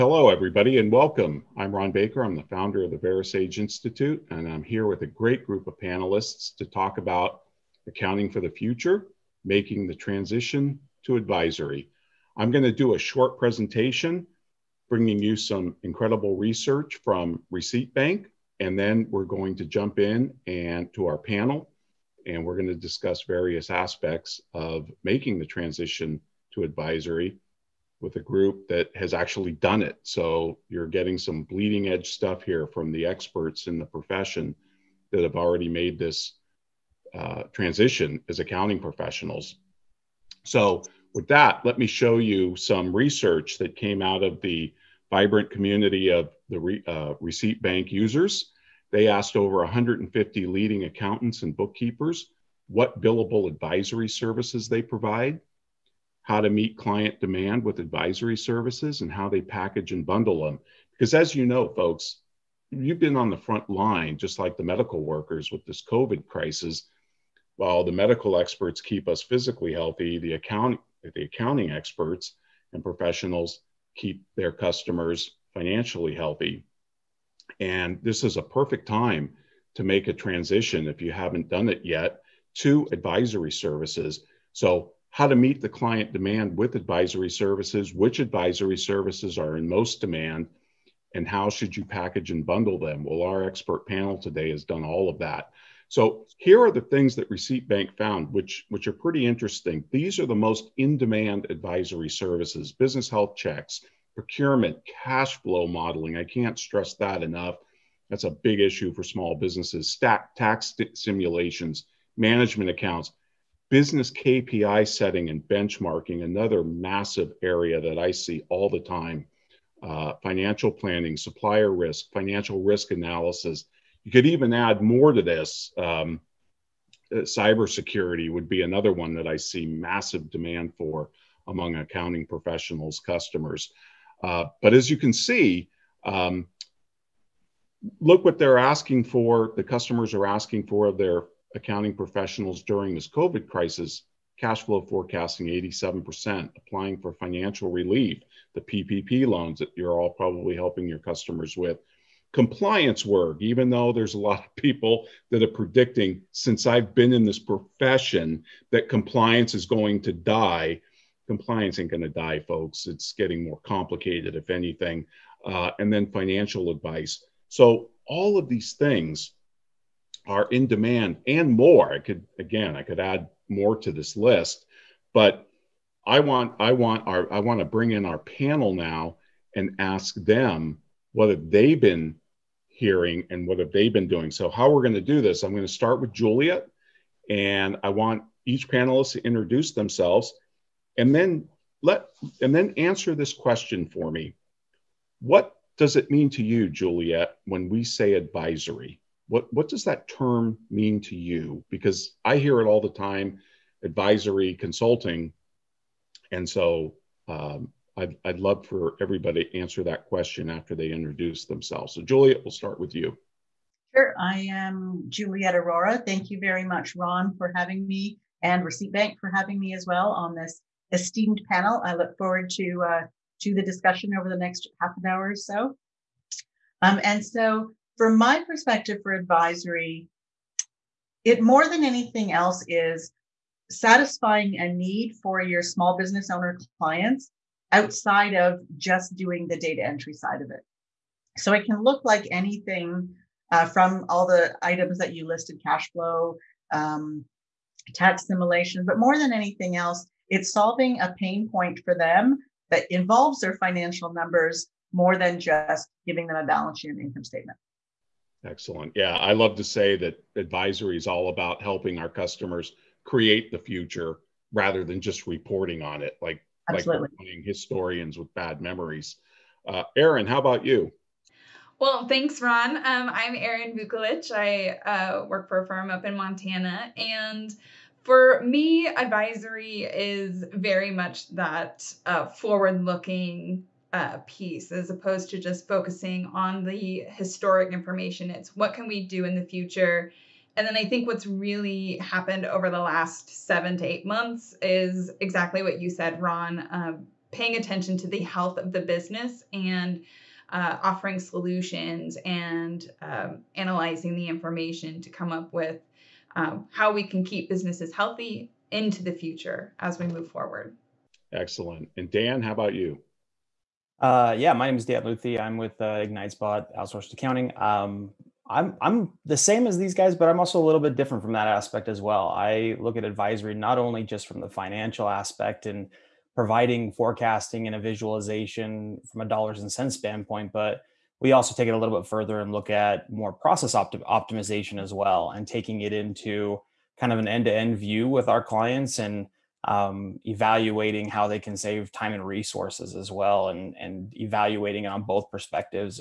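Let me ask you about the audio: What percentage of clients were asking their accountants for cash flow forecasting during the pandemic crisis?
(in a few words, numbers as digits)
87%.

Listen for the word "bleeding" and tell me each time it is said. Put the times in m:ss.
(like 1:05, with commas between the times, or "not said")
0:31.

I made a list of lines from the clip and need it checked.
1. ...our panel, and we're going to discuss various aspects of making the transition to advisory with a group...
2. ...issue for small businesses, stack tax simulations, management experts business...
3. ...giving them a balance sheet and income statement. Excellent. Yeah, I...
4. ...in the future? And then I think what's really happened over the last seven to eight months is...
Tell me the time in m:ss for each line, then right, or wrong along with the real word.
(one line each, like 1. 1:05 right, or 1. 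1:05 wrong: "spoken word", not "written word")
1. 0:21 right
2. 1:48 wrong: "accounts", not "experts"
3. 4:16 right
4. 4:49 right.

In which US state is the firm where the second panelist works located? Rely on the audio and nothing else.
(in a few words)
Montana.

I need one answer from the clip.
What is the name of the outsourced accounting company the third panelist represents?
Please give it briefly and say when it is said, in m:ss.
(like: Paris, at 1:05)
IgniteSpot, at 5:16.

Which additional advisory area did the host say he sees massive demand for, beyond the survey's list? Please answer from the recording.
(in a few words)
cybersecurity.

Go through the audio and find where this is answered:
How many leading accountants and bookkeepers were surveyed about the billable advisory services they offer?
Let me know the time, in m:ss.
0:49.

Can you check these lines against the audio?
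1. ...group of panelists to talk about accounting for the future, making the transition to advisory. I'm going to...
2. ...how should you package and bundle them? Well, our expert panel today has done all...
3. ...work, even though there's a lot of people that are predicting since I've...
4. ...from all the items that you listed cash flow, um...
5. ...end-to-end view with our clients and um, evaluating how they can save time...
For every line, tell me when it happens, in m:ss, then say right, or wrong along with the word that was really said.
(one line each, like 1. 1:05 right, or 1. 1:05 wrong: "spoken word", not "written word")
1. 0:05 right
2. 1:31 right
3. 2:33 right
4. 4:03 right
5. 5:37 right.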